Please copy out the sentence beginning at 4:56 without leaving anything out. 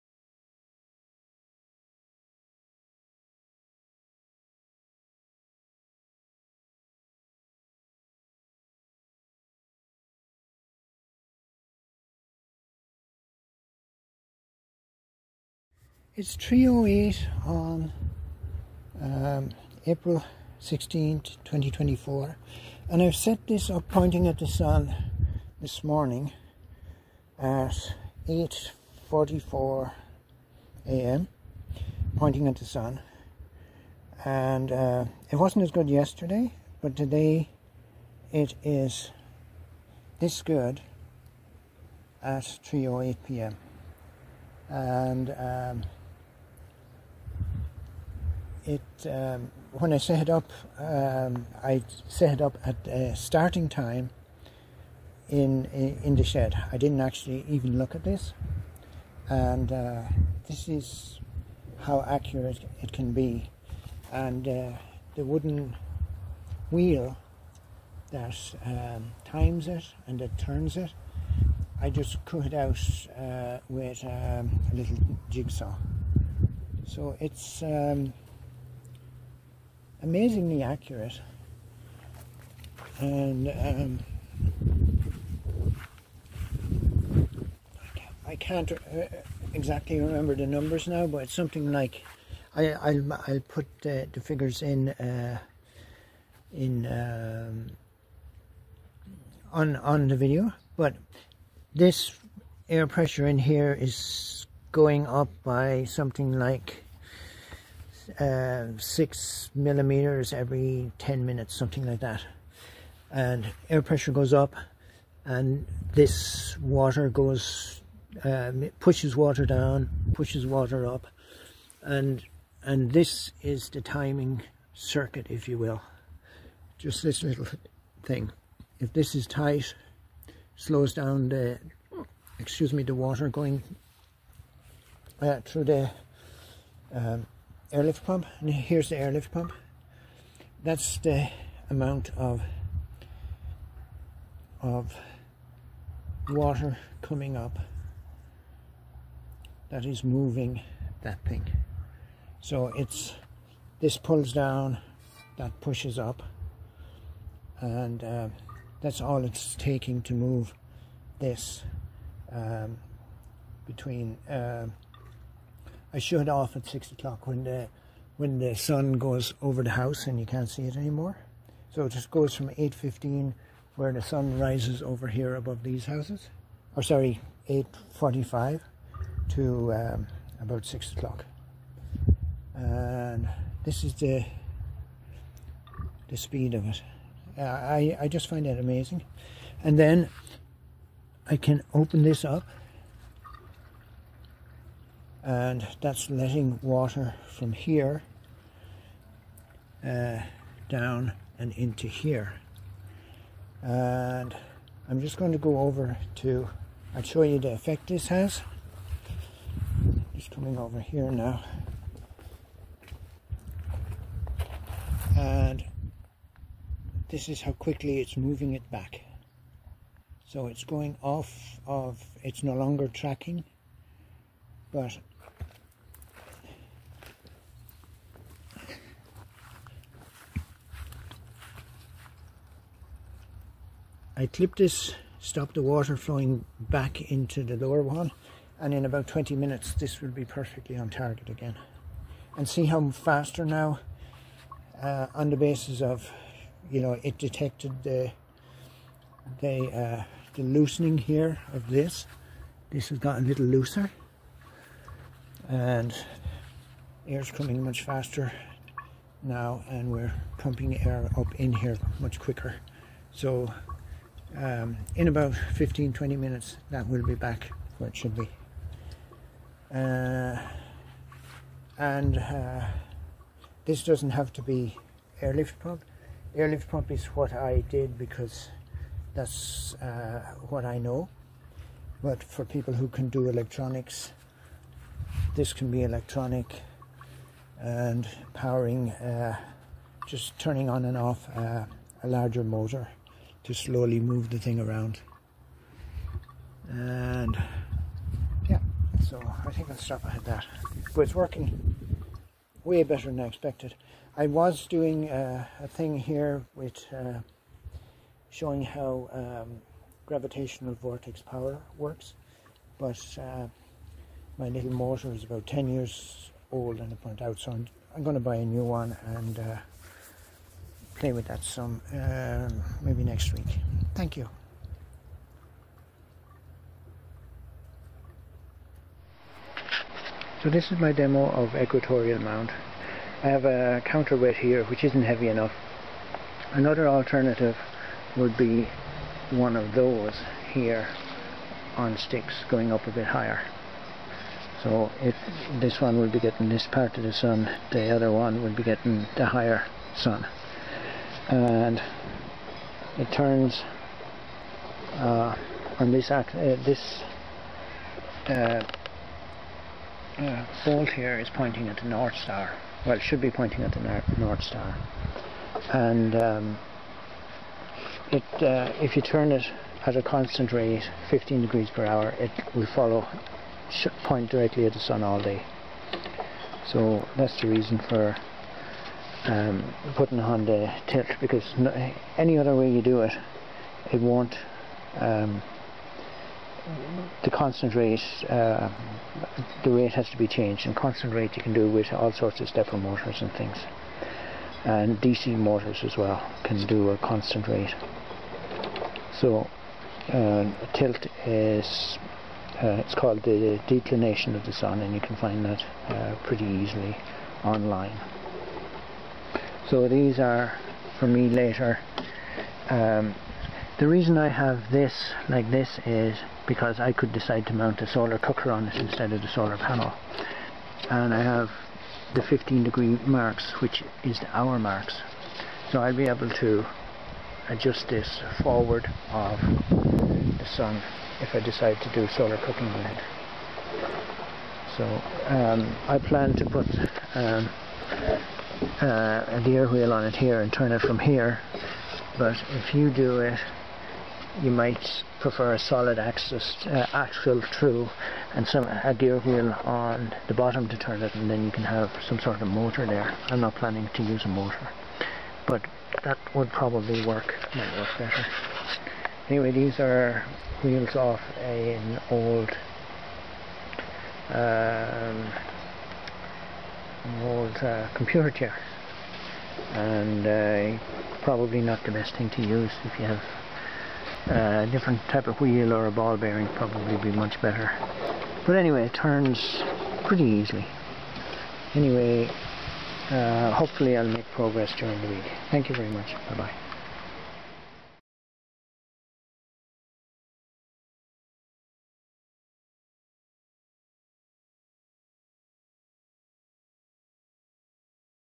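And yeah, so I think I'll stop at that.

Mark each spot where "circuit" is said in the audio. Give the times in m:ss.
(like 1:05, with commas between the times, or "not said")
2:04.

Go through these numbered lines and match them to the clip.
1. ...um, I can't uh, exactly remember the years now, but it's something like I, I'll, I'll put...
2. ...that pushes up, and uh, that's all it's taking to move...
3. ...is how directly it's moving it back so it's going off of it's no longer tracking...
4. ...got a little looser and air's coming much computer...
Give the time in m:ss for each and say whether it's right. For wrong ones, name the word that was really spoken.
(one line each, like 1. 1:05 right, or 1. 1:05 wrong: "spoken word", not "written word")
1. 1:23 wrong: "numbers", not "years"
2. 2:35 right
3. 3:37 wrong: "quickly", not "directly"
4. 4:12 wrong: "faster", not "computer".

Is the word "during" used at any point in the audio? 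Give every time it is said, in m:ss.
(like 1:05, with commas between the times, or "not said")
8:04.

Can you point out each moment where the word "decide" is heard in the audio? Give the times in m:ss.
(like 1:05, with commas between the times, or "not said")
6:57, 7:11.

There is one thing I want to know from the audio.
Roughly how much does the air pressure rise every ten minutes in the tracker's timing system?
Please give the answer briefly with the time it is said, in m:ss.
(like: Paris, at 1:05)
6 millimeters, at 1:48.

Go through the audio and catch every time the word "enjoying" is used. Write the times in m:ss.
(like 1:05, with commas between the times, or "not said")
not said.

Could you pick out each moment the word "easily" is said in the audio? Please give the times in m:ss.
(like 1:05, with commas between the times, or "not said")
6:46, 8:00.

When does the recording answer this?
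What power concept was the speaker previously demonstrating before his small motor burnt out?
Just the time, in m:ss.
5:10.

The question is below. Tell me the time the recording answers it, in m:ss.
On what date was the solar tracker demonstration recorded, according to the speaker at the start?
0:19.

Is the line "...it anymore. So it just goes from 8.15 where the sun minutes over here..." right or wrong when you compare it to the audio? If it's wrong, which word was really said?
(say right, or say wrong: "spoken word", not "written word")
wrong: "rises", not "minutes".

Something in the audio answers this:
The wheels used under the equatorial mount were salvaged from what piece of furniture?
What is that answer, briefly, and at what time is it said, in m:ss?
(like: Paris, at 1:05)
computer chair, at 7:47.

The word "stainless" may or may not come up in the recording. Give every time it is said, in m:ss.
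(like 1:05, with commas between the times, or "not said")
not said.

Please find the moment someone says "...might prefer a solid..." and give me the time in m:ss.
7:24.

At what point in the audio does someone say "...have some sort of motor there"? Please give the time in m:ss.
7:31.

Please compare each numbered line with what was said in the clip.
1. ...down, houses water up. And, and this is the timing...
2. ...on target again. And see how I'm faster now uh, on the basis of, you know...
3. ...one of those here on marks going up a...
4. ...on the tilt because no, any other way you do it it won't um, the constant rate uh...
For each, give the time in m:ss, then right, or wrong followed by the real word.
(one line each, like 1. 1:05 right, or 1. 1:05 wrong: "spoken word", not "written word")
1. 1:59 wrong: "pushes", not "houses"
2. 4:00 right
3. 5:39 wrong: "sticks", not "marks"
4. 6:20 right.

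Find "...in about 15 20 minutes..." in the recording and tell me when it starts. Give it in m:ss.
4:24.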